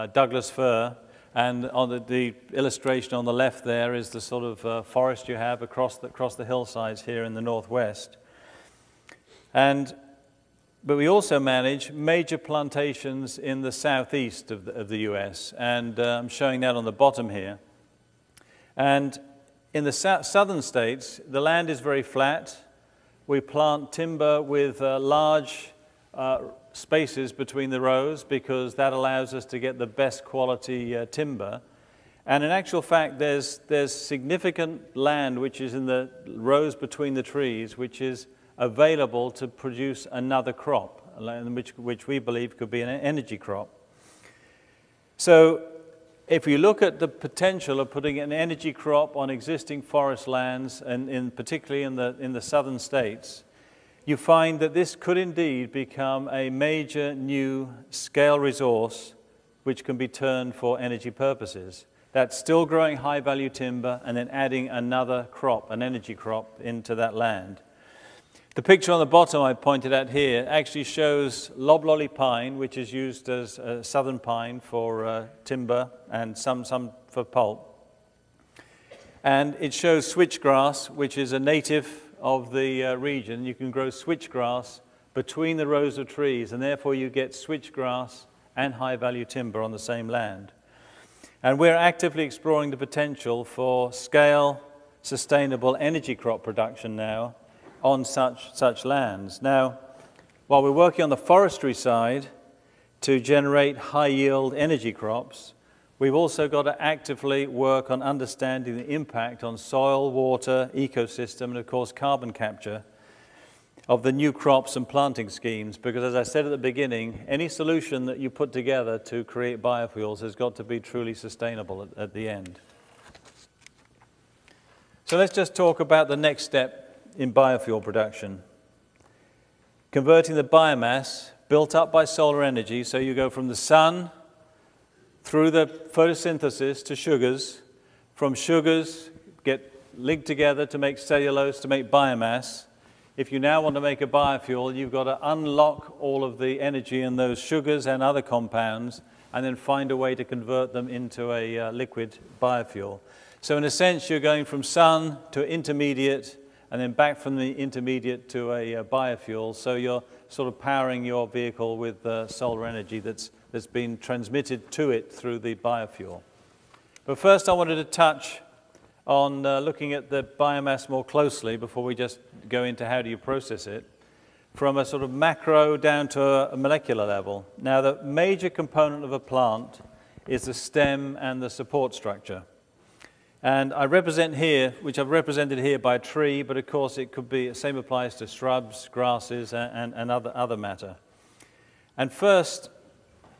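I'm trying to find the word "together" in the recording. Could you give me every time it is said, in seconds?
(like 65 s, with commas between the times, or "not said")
118 s, 140 s.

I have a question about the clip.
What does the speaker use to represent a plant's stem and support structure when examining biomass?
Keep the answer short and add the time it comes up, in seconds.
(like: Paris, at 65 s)
A tree, at 185 s.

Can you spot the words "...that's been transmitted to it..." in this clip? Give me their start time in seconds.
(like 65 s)
163 s.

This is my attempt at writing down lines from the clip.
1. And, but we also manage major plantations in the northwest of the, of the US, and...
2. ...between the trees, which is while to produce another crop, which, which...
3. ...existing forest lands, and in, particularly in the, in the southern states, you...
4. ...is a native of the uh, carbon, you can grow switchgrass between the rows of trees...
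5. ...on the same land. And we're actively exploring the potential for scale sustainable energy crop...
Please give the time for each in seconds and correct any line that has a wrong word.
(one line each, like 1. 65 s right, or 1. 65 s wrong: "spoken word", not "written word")
1. 9 s wrong: "southeast", not "northwest"
2. 36 s wrong: "available", not "while"
3. 49 s right
4. 81 s wrong: "region", not "carbon"
5. 89 s right.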